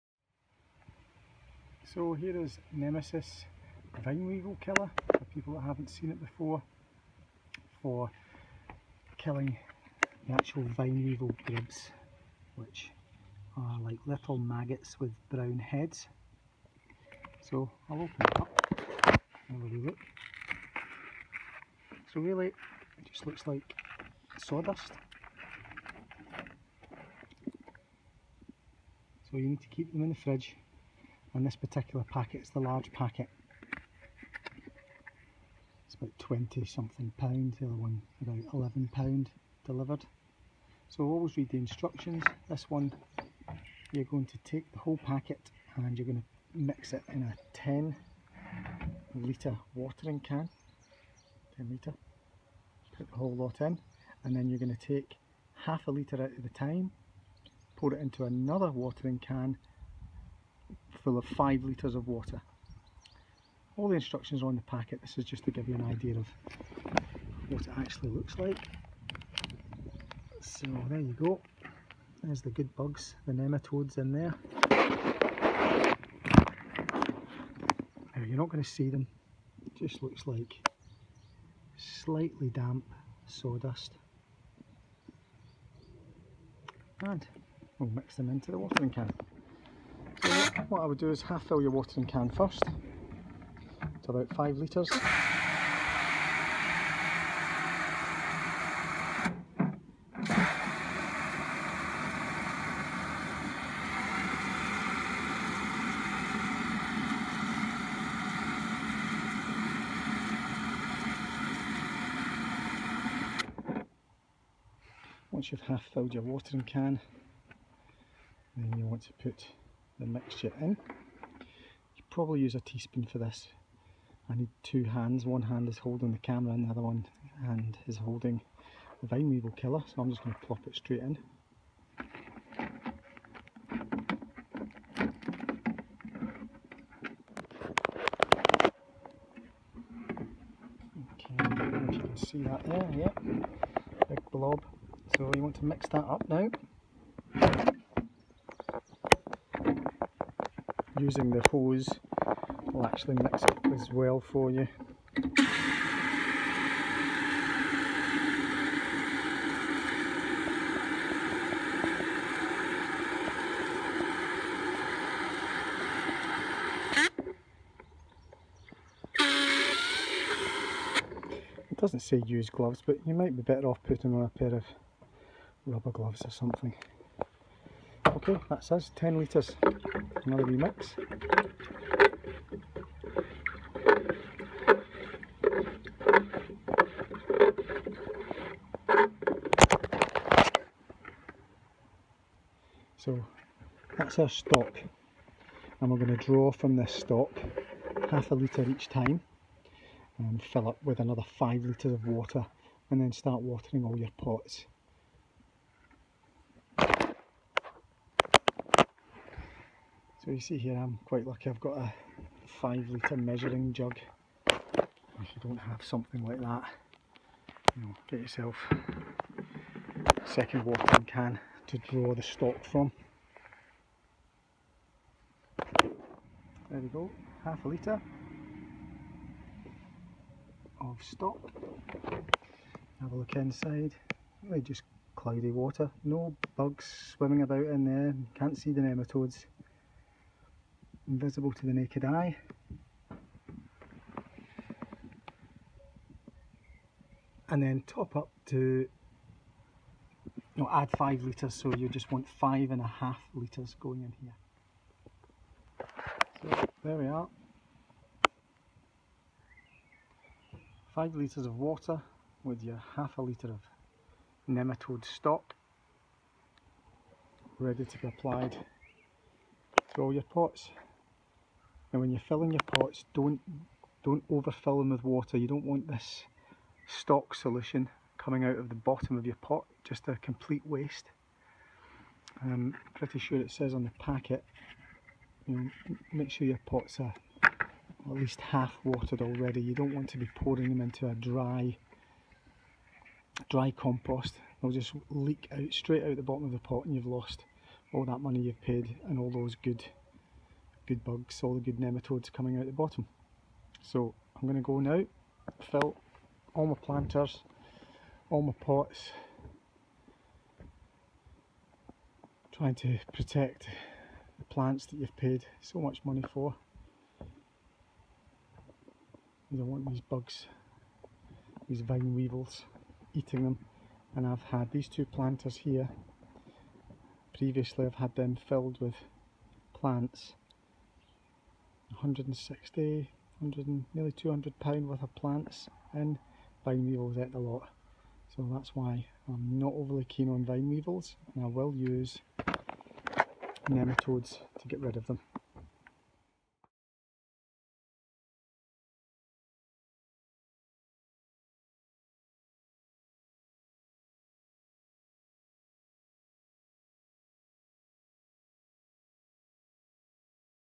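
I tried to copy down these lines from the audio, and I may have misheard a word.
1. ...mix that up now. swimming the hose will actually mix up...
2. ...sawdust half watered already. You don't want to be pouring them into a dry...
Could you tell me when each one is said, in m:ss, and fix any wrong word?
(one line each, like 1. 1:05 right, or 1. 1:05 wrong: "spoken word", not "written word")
1. 2:25 wrong: "using", not "swimming"
2. 4:48 wrong: "least", not "sawdust".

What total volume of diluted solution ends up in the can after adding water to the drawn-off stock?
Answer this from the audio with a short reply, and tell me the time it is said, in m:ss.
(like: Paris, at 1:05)
5.5 litres, at 4:12.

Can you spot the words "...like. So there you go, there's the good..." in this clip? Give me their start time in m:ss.
1:08.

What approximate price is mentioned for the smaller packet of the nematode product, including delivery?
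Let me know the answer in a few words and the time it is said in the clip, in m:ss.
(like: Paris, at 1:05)
£11, at 0:38.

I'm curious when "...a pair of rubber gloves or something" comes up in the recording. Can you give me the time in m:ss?
2:54.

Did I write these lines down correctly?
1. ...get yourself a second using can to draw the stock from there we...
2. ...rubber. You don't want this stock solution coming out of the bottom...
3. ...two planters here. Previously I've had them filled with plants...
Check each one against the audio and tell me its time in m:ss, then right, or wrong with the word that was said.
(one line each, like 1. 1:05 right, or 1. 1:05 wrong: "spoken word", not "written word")
1. 3:38 wrong: "watering", not "using"
2. 4:35 wrong: "water", not "rubber"
3. 5:24 right.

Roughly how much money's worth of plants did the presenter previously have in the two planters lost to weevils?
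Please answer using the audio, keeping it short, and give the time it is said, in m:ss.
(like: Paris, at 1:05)
nearly £200, at 5:33.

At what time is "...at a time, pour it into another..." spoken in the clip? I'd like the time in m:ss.
0:56.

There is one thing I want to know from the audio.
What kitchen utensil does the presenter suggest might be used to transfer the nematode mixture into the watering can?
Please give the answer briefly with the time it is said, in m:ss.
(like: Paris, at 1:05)
teaspoon, at 2:02.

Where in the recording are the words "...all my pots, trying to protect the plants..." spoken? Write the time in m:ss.
5:08.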